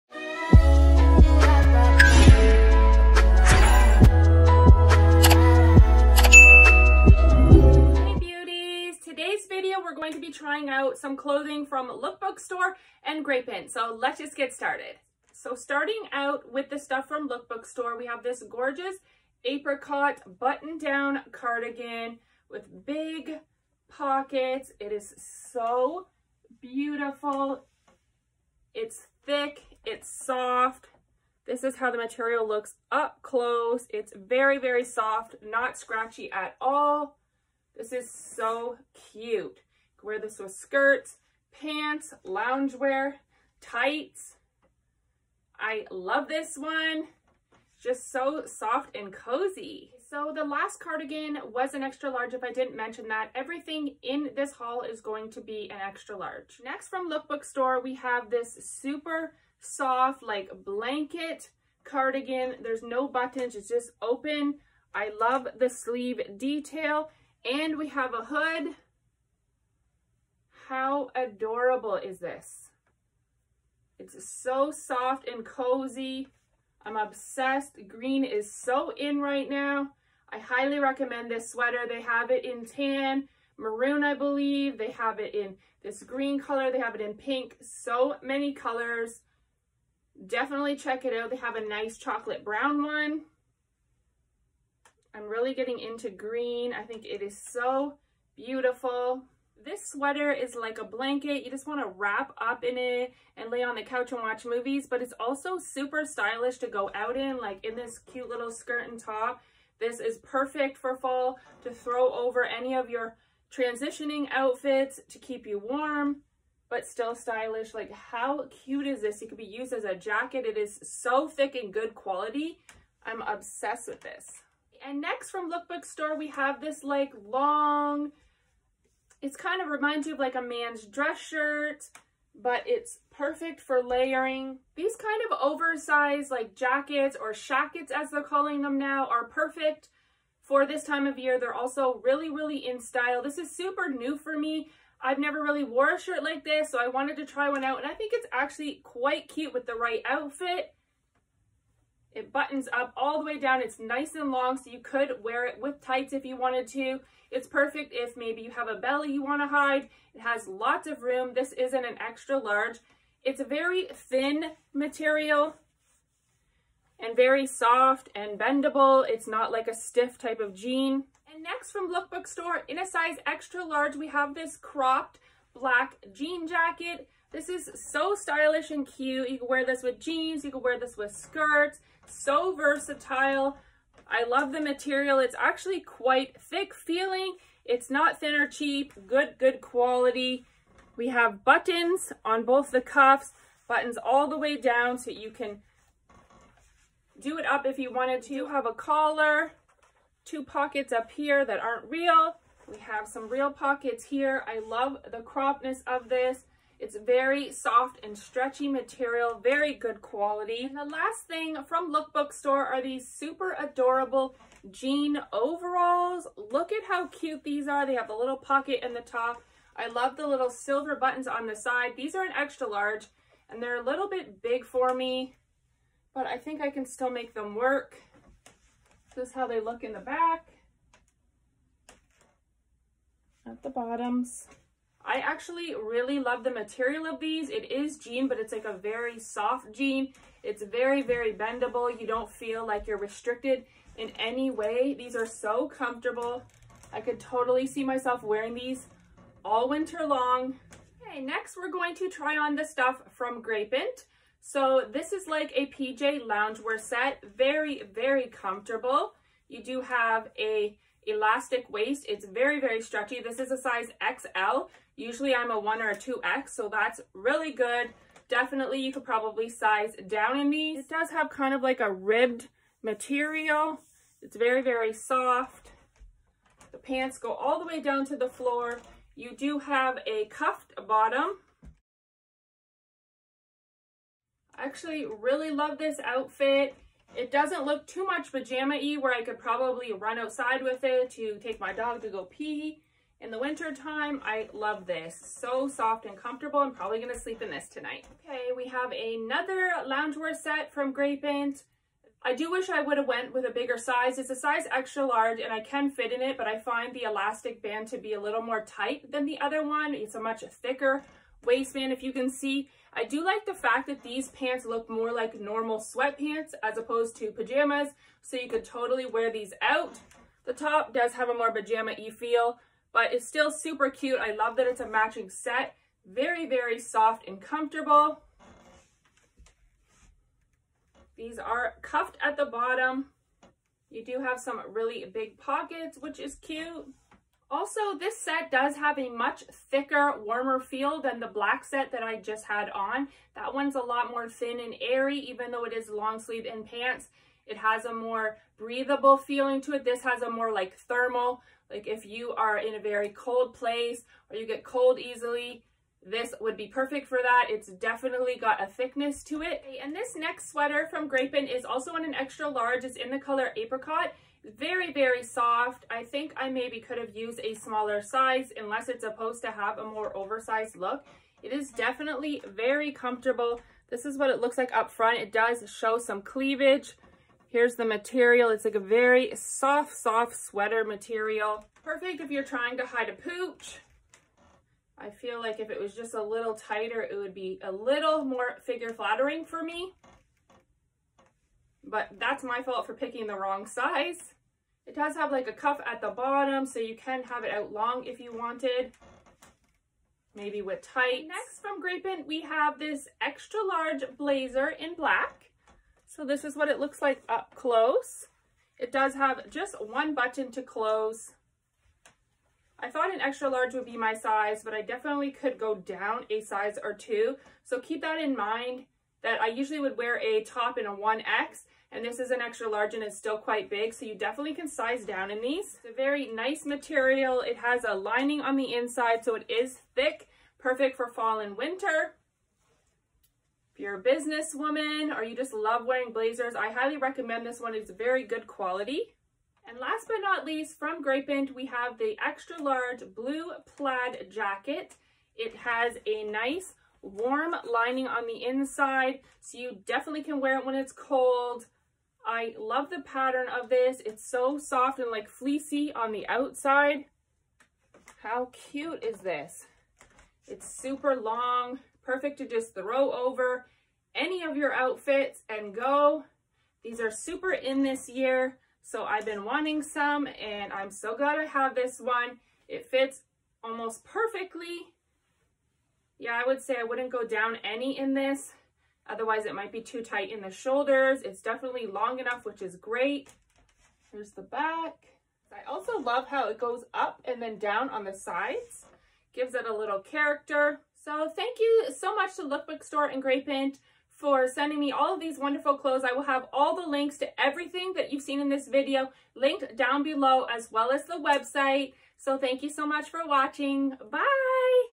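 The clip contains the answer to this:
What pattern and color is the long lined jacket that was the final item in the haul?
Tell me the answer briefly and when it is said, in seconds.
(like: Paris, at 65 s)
Blue plaid, at 443 s.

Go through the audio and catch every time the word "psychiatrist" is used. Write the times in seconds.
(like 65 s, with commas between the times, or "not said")
not said.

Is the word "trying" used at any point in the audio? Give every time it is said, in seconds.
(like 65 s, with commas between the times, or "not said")
10 s, 382 s.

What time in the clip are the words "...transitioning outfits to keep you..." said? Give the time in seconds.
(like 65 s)
113 s.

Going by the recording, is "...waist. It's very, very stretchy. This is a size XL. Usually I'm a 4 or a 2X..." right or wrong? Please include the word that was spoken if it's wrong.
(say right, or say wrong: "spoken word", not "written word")
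wrong: "1", not "4".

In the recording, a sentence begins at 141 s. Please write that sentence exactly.
They're also really, really in style.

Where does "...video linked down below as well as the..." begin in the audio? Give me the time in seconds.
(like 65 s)
498 s.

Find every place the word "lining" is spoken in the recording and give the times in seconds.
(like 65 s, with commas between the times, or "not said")
427 s, 447 s.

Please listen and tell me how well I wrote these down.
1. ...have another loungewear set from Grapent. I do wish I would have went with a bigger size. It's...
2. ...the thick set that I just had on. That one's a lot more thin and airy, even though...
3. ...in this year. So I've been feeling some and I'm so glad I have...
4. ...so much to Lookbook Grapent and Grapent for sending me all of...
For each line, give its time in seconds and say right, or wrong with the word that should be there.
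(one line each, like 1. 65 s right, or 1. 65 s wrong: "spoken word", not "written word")
1. 298 s right
2. 341 s wrong: "black", not "thick"
3. 467 s wrong: "wanting", not "feeling"
4. 491 s wrong: "Store", not "Grapent".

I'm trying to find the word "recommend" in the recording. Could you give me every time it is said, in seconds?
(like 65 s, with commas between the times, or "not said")
80 s, 436 s.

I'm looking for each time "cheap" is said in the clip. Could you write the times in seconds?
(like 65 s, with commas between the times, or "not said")
188 s.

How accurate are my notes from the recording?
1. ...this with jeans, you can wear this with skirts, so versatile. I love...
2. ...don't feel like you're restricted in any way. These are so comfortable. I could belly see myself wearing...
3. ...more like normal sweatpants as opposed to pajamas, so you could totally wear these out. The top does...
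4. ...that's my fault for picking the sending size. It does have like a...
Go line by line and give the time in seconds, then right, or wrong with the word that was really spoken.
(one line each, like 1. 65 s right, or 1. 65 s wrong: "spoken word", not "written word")
1. 179 s right
2. 242 s wrong: "totally", not "belly"
3. 314 s right
4. 392 s wrong: "wrong", not "sending".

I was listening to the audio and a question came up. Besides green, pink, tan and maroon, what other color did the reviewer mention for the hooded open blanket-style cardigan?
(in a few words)
Chocolate brown.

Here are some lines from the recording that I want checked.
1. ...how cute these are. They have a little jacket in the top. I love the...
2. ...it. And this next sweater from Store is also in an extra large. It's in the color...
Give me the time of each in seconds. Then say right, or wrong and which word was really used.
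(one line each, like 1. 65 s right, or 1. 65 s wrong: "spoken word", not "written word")
1. 216 s wrong: "pocket", not "jacket"
2. 359 s wrong: "Grapent", not "Store".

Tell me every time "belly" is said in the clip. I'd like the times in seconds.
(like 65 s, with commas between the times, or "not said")
158 s.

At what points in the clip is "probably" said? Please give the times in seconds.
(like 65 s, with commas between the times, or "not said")
269 s, 289 s, 296 s.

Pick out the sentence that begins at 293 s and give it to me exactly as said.
In the winter time, I love this.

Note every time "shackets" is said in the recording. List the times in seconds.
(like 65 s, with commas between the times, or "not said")
137 s.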